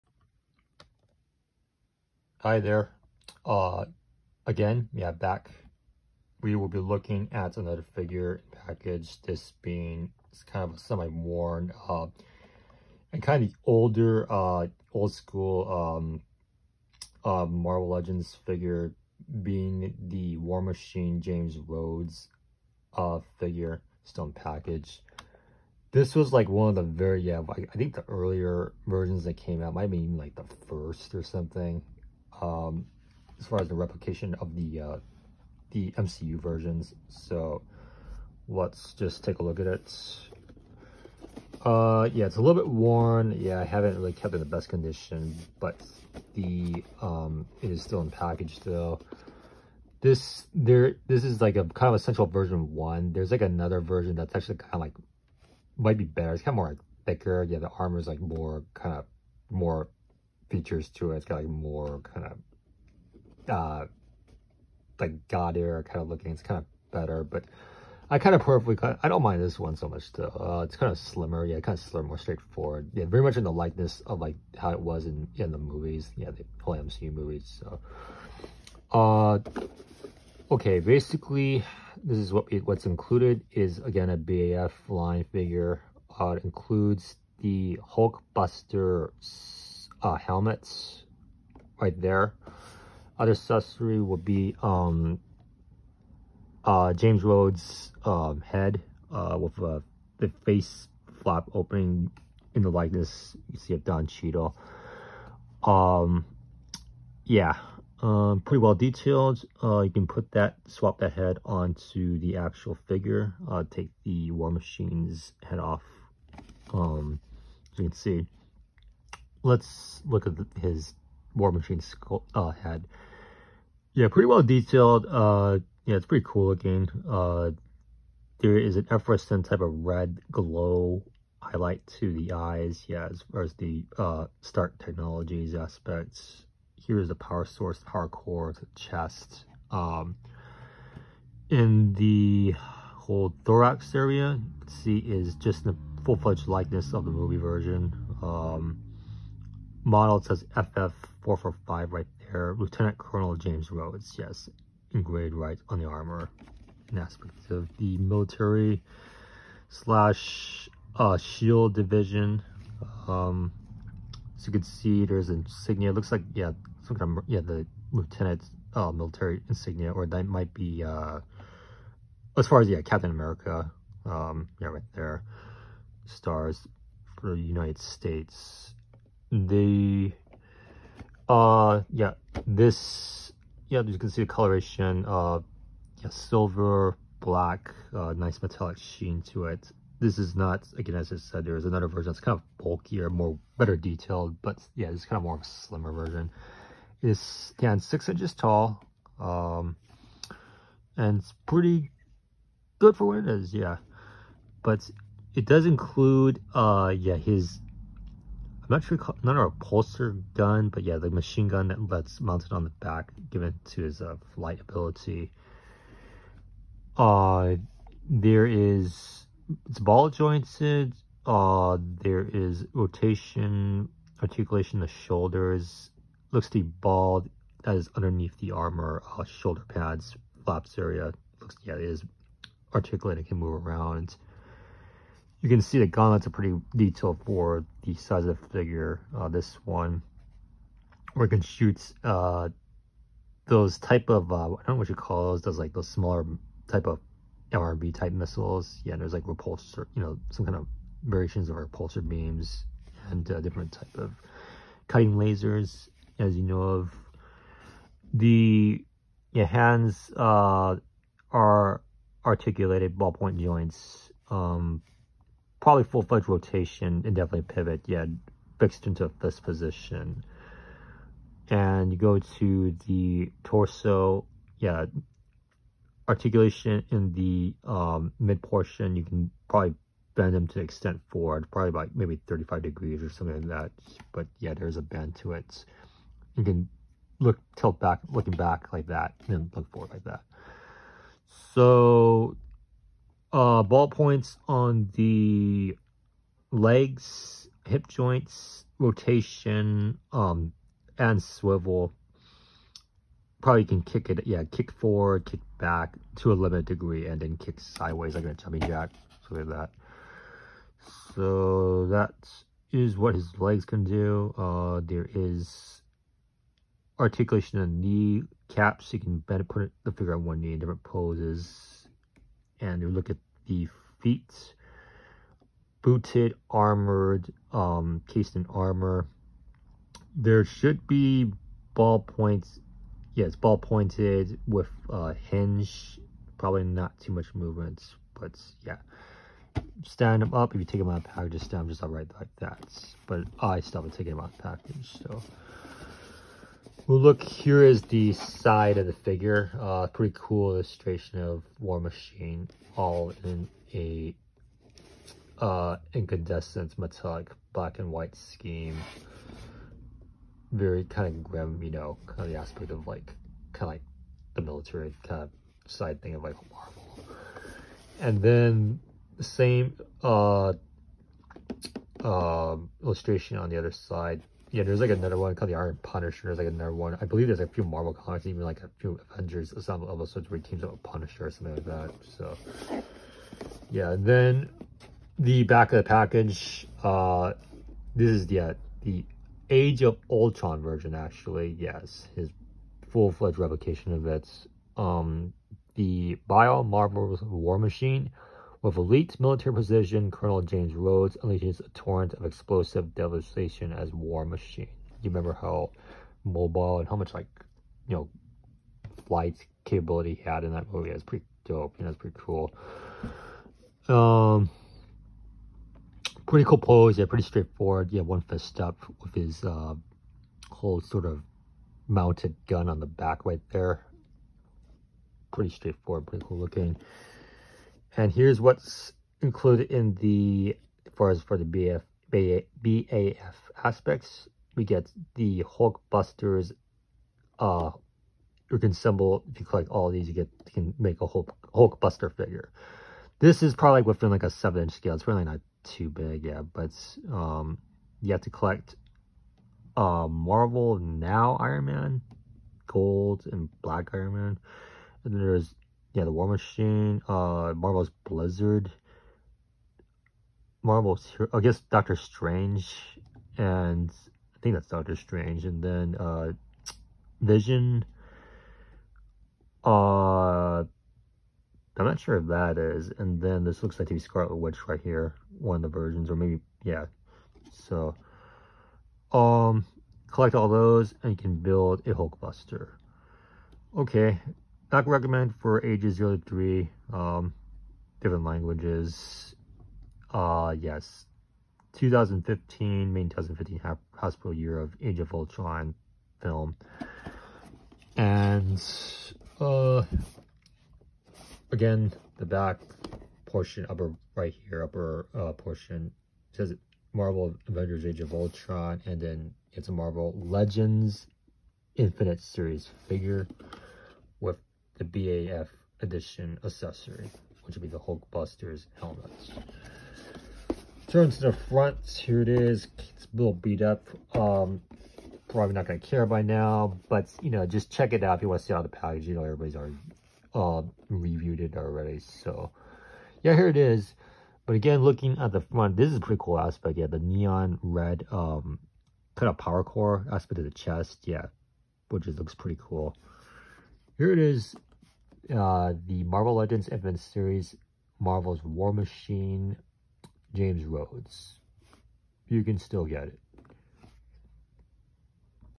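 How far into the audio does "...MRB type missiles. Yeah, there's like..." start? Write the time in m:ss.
4:07.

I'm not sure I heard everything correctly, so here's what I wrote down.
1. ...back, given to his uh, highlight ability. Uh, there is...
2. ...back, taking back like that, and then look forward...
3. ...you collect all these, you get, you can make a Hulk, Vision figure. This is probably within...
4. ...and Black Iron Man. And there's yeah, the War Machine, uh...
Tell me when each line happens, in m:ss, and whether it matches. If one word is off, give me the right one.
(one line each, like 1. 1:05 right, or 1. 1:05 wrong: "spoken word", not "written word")
1. 3:32 wrong: "flight", not "highlight"
2. 4:47 wrong: "looking", not "taking"
3. 7:19 wrong: "Hulkbuster", not "Vision"
4. 7:33 right.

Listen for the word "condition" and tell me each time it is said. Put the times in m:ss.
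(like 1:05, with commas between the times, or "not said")
0:44.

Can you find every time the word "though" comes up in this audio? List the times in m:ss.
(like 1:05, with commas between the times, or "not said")
0:48, 1:10.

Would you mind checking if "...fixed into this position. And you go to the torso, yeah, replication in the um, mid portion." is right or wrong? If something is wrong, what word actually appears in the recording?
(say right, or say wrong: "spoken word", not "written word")
wrong: "articulation", not "replication".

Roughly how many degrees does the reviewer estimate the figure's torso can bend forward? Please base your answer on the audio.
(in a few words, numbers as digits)
35 degrees.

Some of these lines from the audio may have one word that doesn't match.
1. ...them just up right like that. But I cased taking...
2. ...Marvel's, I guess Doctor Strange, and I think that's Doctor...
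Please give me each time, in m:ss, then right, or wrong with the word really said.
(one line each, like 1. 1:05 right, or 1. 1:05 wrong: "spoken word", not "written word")
1. 5:41 wrong: "stopped", not "cased"
2. 7:40 right.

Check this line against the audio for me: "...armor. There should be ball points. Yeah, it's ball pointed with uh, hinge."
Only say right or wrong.
right.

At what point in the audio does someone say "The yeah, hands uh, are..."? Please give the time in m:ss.
4:18.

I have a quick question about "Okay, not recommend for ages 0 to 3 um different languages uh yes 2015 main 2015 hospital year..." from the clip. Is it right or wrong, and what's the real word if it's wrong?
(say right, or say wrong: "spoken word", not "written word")
right.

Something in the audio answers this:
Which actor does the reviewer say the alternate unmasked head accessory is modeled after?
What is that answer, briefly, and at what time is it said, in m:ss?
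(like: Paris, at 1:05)
Don Cheadle, at 1:43.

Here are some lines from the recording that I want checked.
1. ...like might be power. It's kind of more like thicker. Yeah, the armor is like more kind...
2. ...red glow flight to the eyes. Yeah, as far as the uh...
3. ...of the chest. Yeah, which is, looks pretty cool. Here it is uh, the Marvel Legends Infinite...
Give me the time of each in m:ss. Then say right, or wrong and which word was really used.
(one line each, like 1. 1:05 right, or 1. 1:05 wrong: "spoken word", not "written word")
1. 0:54 wrong: "better", not "power"
2. 2:09 wrong: "highlight", not "flight"
3. 9:00 right.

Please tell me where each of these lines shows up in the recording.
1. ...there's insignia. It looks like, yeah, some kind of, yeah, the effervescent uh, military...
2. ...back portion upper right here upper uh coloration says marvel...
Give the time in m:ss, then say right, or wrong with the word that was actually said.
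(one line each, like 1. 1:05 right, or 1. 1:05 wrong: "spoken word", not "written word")
1. 2:45 wrong: "lieutenant", not "effervescent"
2. 8:22 wrong: "portion", not "coloration".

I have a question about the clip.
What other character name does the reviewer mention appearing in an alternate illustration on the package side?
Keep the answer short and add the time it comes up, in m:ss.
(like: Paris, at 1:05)
Iron Punisher, at 6:15.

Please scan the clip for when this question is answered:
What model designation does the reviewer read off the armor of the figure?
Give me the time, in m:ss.
2:30.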